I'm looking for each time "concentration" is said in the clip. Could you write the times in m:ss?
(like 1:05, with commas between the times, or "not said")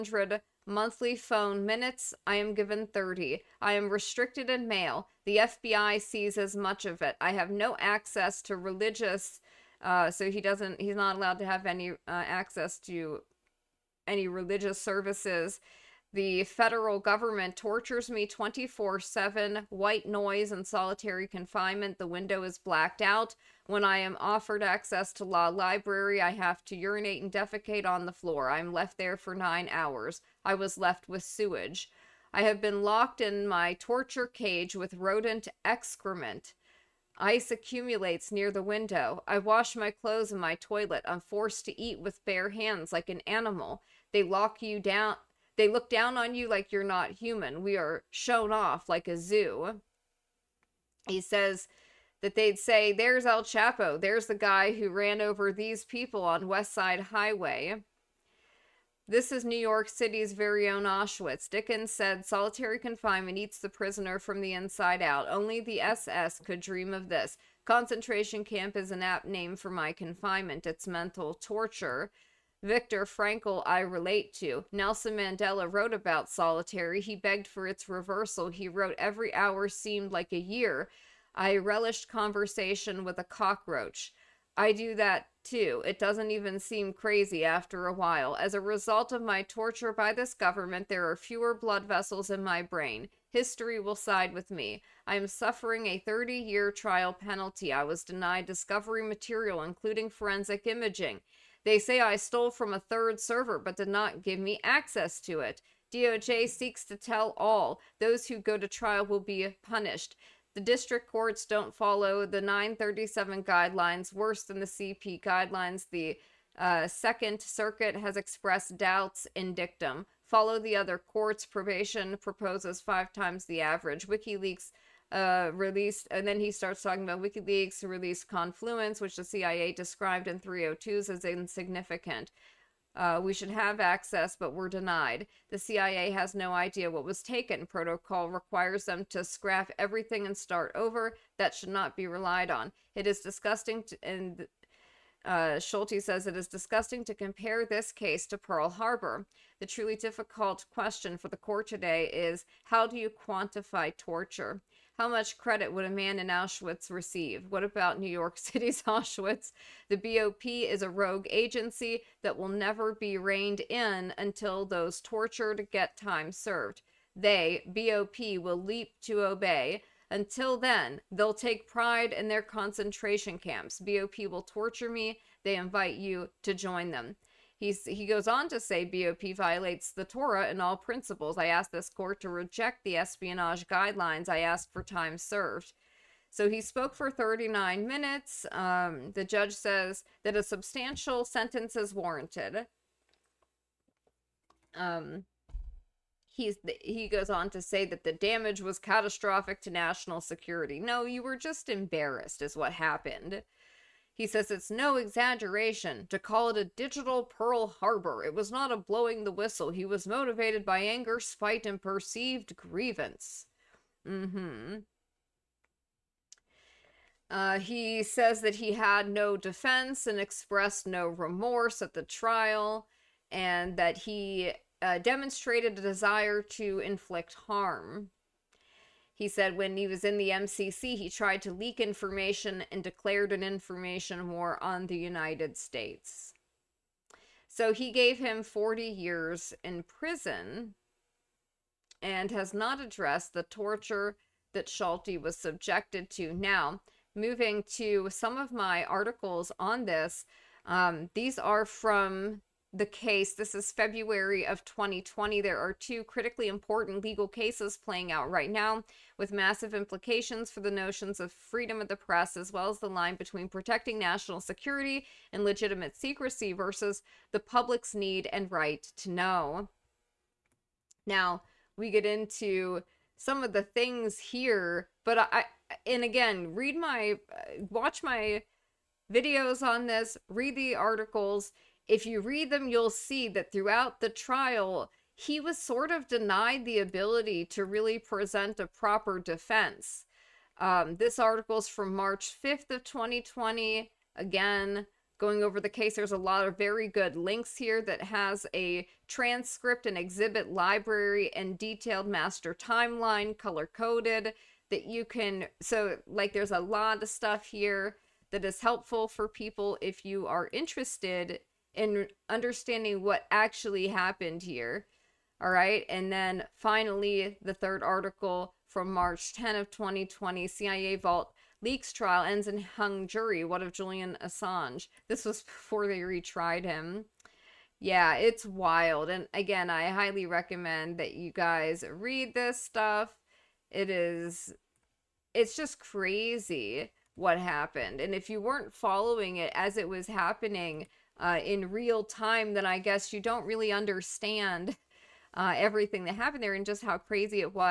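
1:07, 2:52.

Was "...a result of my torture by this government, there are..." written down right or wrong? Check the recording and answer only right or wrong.
right.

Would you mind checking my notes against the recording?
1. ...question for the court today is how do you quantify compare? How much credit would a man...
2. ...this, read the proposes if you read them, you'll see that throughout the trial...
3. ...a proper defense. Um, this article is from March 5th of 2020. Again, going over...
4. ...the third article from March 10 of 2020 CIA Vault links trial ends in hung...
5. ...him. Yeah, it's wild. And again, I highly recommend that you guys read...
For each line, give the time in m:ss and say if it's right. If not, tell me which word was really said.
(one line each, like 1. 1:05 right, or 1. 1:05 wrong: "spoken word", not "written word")
1. 2:30 wrong: "torture", not "compare"
2. 4:39 wrong: "articles", not "proposes"
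3. 4:48 right
4. 5:17 wrong: "leaks", not "links"
5. 5:26 right.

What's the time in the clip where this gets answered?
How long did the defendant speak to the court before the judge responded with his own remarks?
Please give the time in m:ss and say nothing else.
3:07.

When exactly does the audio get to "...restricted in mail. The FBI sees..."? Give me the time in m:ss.
0:03.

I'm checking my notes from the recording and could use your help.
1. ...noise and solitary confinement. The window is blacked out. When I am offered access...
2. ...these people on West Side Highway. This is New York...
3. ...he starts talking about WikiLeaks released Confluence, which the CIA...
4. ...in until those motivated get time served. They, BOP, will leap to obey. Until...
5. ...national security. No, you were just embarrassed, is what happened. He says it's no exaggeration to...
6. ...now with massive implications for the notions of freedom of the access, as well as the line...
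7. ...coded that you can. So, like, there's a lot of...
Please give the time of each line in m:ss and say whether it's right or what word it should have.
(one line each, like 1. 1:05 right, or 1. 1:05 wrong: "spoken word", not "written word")
1. 0:20 right
2. 0:55 right
3. 2:06 right
4. 2:43 wrong: "tortured", not "motivated"
5. 3:19 right
6. 4:18 wrong: "press", not "access"
7. 5:03 right.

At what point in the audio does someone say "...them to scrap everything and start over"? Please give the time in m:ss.
2:18.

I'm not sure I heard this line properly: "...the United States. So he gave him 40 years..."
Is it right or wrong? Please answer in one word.
right.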